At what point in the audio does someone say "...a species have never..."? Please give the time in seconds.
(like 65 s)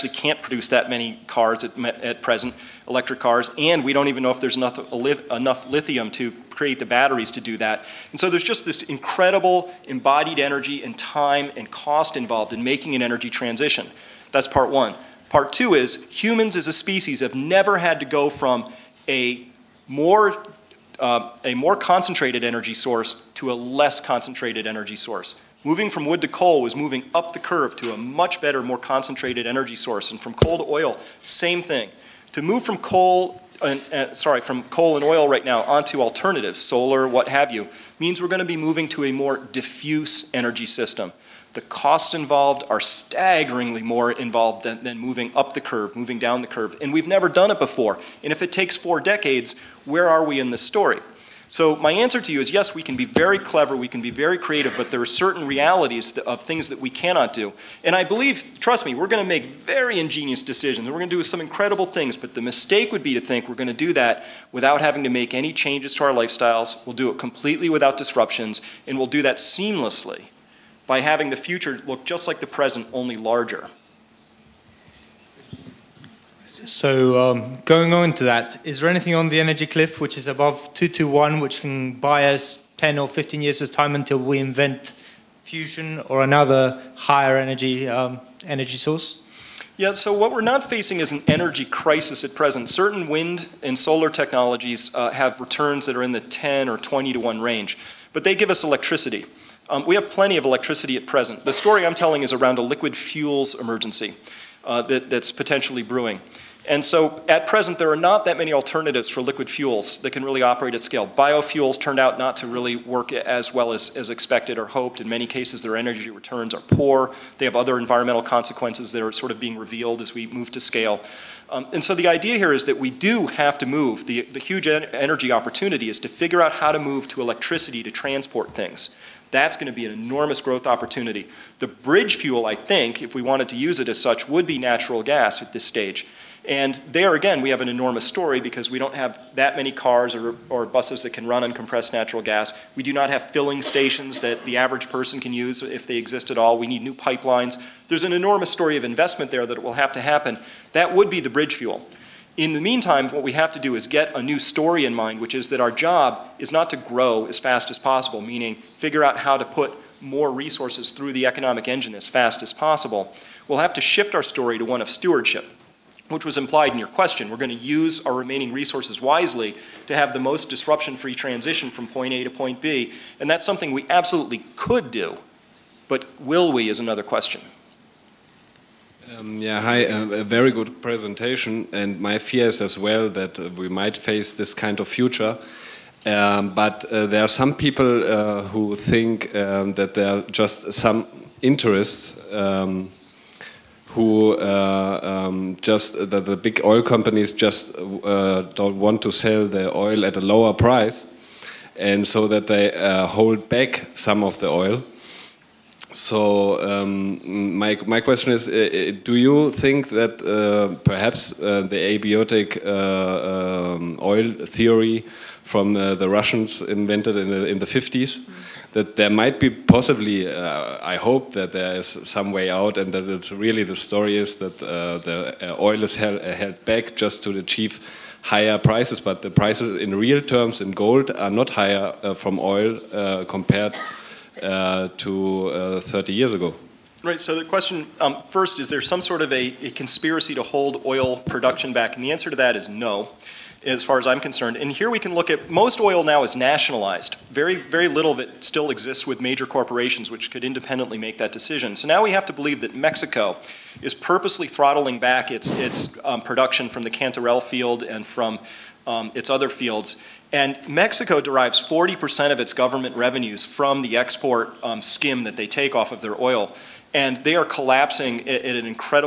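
16 s.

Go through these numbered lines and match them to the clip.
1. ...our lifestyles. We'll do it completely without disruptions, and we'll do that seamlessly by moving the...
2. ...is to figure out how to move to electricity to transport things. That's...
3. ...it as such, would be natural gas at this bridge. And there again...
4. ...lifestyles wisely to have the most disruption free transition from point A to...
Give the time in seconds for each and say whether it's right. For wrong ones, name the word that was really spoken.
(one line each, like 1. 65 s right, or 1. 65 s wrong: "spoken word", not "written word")
1. 66 s wrong: "having", not "moving"
2. 125 s right
3. 133 s wrong: "stage", not "bridge"
4. 168 s wrong: "resources", not "lifestyles".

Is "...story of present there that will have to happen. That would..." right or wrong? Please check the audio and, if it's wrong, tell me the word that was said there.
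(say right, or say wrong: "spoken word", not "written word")
wrong: "investment", not "present".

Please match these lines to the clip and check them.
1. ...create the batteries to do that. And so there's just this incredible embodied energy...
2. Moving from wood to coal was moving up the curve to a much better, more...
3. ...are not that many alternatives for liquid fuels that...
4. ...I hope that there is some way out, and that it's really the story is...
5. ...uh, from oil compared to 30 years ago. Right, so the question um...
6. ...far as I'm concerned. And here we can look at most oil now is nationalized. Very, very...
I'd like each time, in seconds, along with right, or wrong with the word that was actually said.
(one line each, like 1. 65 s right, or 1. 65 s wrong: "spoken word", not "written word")
1. 6 s right
2. 25 s right
3. 107 s right
4. 220 s right
5. 232 s right
6. 243 s right.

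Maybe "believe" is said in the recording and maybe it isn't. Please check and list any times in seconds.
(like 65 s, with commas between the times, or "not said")
58 s, 252 s.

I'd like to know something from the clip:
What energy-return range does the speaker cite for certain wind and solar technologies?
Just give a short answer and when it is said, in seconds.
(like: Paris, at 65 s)
10 or 20 to 1, at 96 s.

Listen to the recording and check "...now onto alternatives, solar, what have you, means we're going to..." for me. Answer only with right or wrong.
right.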